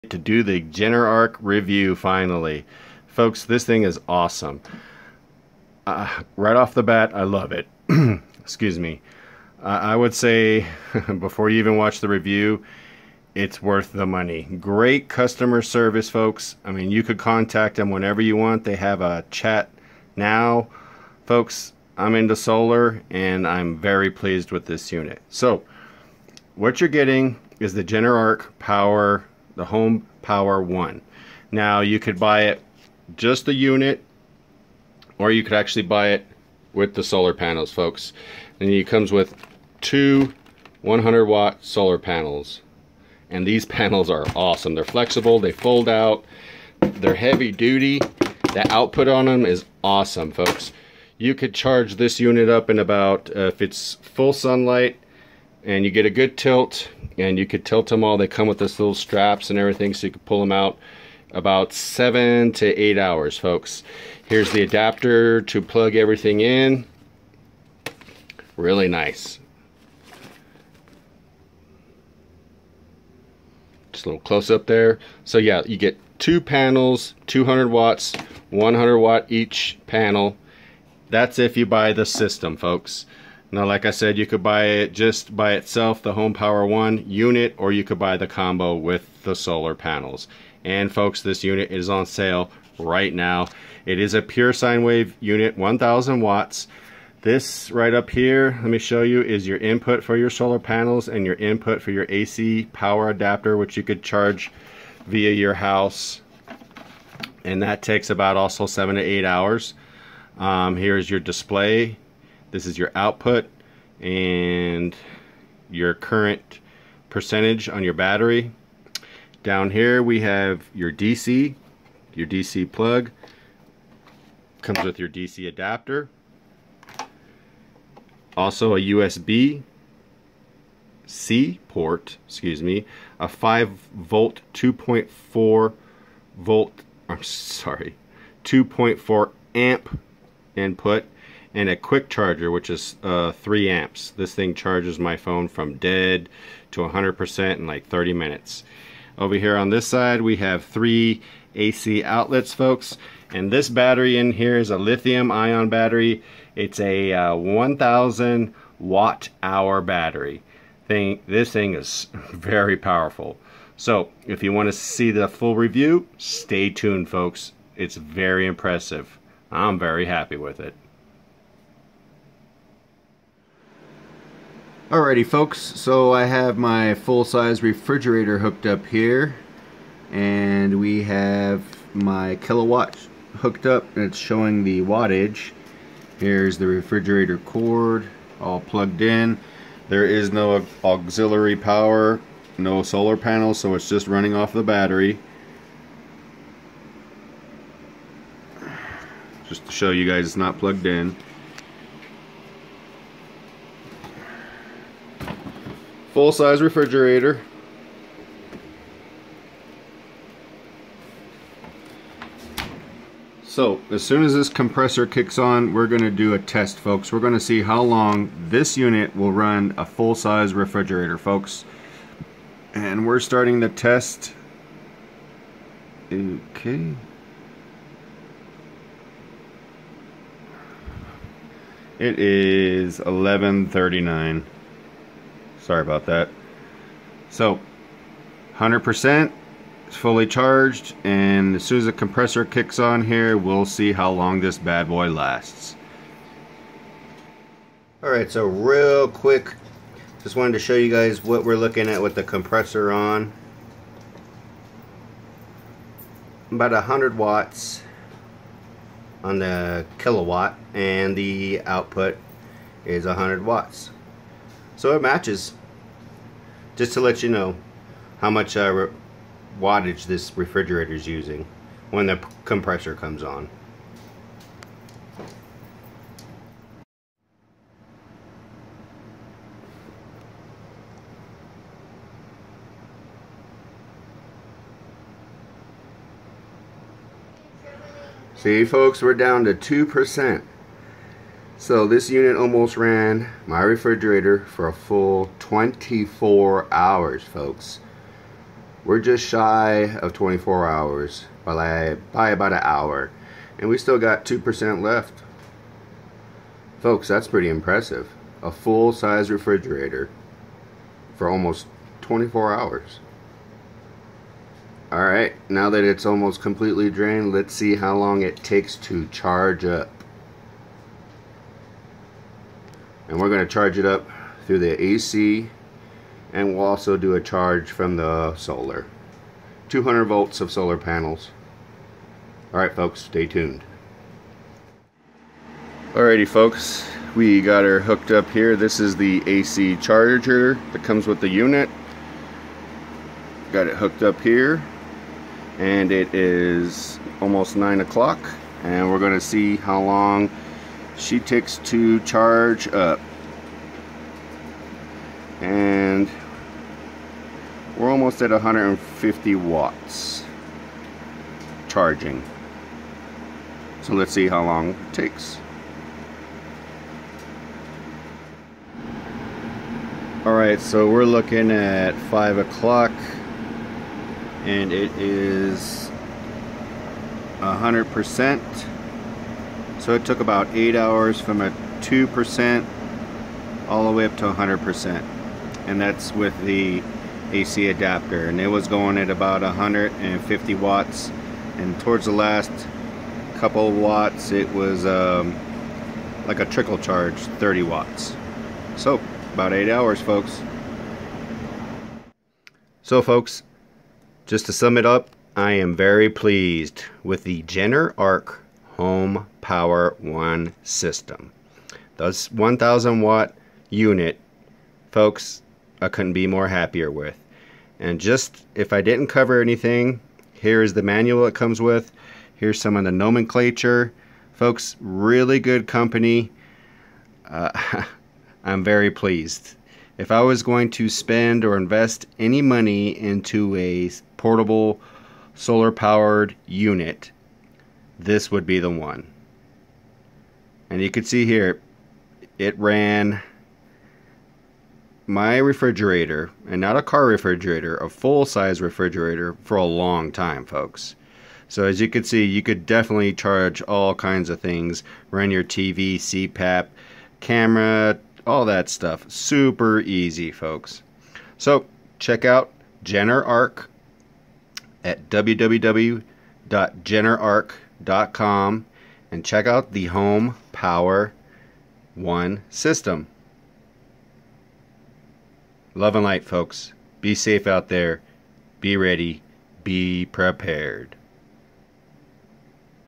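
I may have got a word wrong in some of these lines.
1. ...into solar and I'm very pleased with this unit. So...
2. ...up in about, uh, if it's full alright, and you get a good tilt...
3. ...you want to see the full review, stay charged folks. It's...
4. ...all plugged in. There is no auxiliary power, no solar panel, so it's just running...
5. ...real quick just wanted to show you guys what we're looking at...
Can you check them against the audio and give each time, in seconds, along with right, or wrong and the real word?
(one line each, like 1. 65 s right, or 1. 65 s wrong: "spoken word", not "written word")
1. 22 s right
2. 52 s wrong: "sunlight", not "alright"
3. 164 s wrong: "tuned", not "charged"
4. 188 s right
5. 248 s right.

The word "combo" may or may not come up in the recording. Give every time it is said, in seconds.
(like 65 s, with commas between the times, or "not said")
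88 s.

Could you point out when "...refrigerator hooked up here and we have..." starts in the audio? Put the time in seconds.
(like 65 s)
177 s.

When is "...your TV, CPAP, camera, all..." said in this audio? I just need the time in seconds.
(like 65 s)
455 s.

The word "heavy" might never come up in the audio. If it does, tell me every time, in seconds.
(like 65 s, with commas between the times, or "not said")
47 s.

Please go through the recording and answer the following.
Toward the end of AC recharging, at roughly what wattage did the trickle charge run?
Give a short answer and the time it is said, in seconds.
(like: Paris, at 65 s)
30 watts, at 397 s.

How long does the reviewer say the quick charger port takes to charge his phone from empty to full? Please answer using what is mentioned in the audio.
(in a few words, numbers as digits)
30 minutes.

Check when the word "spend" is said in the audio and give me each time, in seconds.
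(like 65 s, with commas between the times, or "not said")
430 s.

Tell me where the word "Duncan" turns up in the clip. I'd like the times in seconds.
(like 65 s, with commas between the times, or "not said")
not said.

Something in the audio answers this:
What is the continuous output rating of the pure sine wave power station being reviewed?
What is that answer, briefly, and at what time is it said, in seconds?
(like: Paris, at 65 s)
1000 watts, at 95 s.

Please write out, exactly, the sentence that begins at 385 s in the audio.
And that's with the AC adapter.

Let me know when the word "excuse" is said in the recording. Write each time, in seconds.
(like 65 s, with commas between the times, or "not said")
8 s, 132 s.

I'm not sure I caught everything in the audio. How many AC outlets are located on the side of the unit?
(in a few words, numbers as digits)
3.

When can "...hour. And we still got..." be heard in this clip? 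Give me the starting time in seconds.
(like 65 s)
302 s.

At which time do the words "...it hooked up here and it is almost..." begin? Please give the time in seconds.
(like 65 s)
343 s.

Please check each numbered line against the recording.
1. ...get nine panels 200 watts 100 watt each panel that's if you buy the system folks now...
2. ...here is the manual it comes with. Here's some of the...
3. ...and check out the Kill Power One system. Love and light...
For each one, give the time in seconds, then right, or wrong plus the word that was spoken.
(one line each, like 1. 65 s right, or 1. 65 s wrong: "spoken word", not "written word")
1. 75 s wrong: "two", not "nine"
2. 420 s right
3. 469 s wrong: "Home", not "Kill".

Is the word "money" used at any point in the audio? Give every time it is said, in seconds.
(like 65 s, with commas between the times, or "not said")
14 s, 432 s.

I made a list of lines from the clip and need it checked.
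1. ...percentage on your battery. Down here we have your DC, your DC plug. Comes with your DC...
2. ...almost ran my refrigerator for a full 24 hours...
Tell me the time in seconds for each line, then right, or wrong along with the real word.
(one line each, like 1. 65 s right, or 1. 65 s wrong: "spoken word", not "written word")
1. 117 s right
2. 292 s right.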